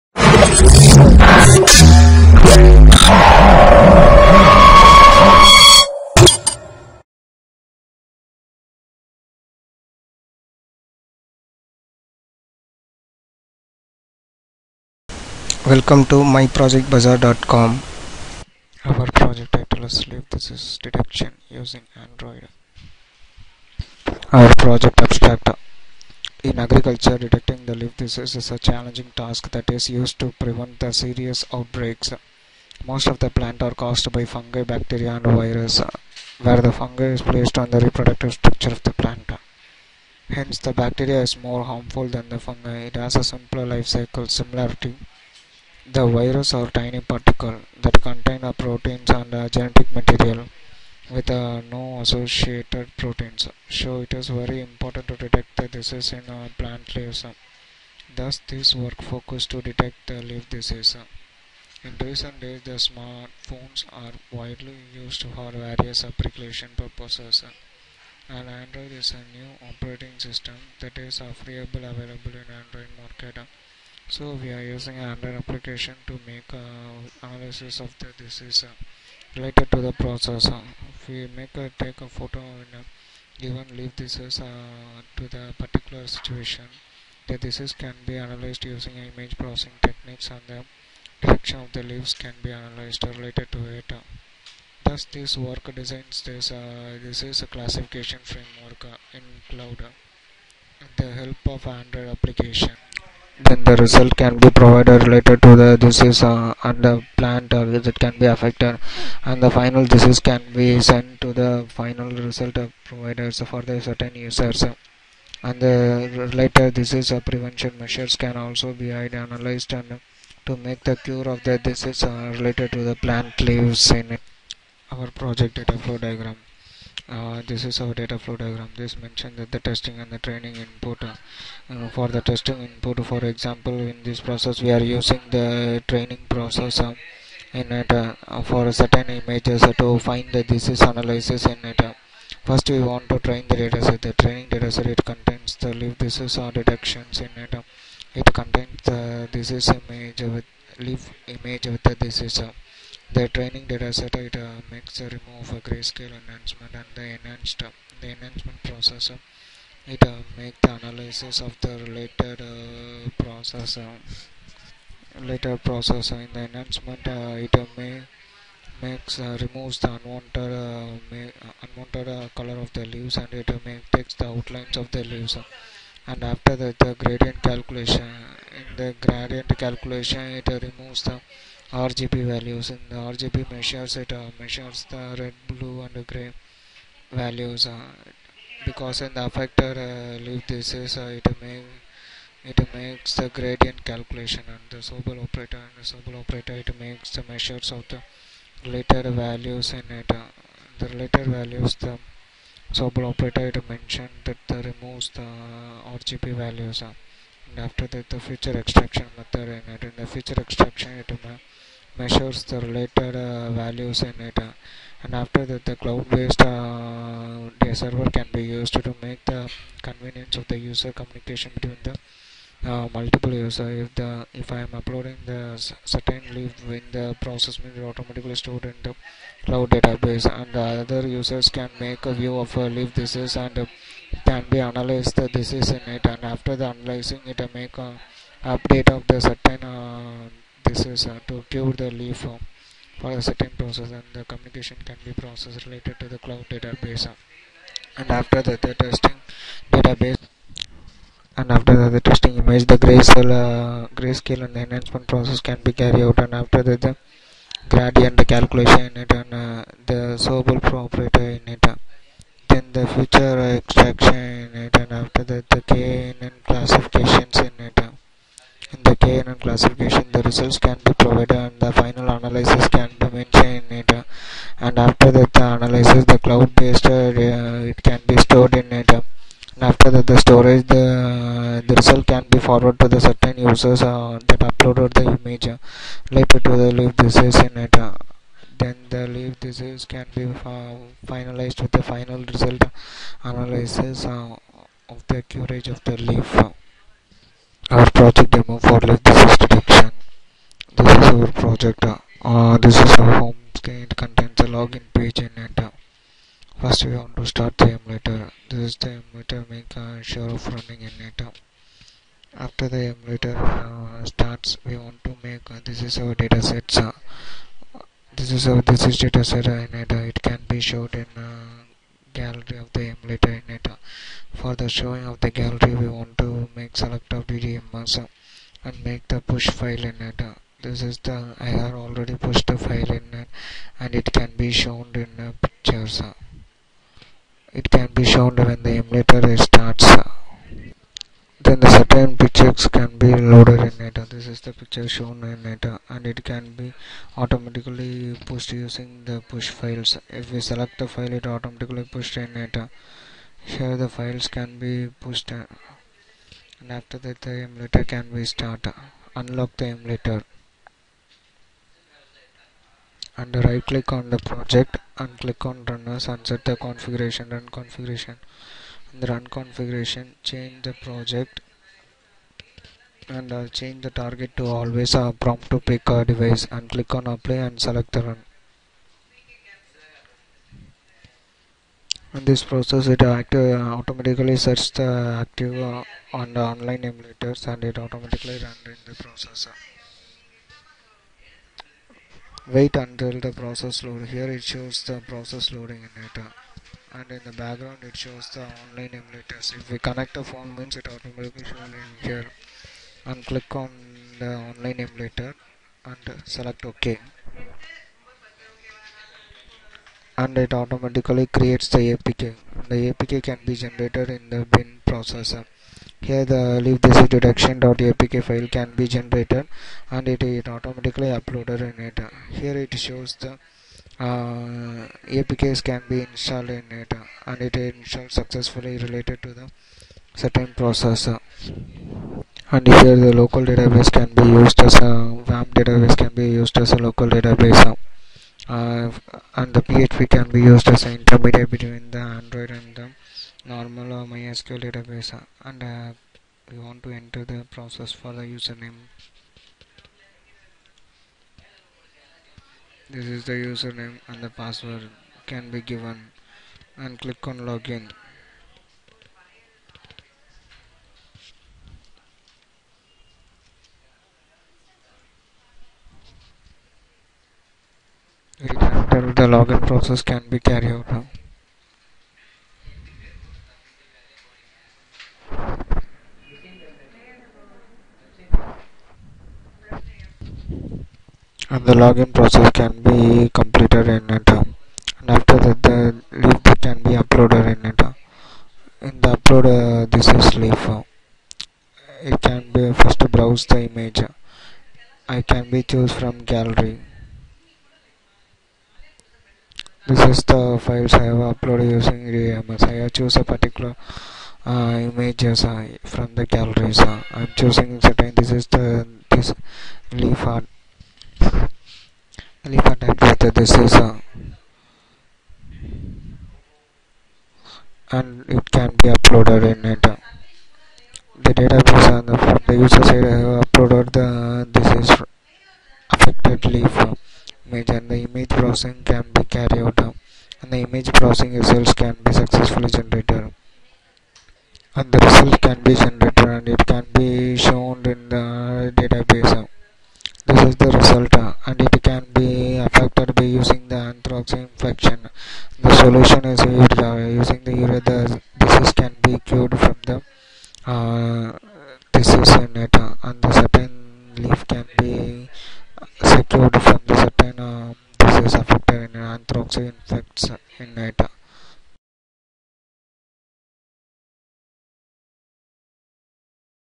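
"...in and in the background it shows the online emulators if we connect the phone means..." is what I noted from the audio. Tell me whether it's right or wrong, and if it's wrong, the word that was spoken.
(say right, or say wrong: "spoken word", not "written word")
right.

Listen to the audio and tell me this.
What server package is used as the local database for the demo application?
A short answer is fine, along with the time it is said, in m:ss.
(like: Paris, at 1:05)
WAMP, at 7:15.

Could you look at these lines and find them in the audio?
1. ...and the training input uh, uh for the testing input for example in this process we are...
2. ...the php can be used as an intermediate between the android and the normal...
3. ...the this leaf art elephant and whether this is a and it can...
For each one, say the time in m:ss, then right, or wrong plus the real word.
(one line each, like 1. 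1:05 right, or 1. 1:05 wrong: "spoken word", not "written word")
1. 2:09 right
2. 7:19 right
3. 8:28 right.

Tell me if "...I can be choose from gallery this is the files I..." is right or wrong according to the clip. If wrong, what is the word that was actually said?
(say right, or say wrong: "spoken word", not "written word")
right.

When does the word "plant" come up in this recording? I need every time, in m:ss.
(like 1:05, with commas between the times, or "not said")
0:33, 0:38, 0:56, 1:47, 2:02.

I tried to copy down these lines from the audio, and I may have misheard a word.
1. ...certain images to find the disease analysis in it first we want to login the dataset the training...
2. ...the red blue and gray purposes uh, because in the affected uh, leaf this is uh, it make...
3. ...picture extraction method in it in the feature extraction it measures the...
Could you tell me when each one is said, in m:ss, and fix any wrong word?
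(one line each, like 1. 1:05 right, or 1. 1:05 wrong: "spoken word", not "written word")
1. 2:18 wrong: "train", not "login"
2. 3:04 wrong: "values", not "purposes"
3. 3:28 wrong: "feature", not "picture".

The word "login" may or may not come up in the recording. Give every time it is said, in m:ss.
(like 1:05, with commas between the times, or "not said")
5:04, 7:37, 7:49, 8:01.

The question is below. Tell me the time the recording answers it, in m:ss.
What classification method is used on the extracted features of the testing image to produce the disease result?
4:25.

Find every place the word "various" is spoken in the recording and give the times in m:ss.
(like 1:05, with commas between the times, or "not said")
1:05.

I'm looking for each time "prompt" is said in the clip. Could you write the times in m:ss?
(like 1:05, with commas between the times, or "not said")
6:15.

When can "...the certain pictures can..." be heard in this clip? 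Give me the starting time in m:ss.
5:41.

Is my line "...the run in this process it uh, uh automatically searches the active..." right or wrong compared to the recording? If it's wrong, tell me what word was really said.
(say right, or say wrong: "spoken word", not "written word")
right.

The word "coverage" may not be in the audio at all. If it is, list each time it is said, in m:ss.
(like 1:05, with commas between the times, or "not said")
4:55.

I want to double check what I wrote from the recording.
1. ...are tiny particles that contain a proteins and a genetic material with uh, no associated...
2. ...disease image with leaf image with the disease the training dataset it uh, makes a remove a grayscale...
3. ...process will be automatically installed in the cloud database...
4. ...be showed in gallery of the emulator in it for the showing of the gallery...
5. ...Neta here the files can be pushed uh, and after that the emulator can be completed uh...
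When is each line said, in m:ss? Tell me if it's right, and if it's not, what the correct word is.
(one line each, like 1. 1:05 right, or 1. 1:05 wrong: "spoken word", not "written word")
1. 0:46 right
2. 2:29 right
3. 3:47 wrong: "stored", not "installed"
4. 5:20 right
5. 5:52 wrong: "started", not "completed".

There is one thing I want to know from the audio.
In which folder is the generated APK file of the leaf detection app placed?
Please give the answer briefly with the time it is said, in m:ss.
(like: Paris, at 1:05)
bin, at 6:54.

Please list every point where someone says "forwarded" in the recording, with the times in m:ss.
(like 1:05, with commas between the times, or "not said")
4:42.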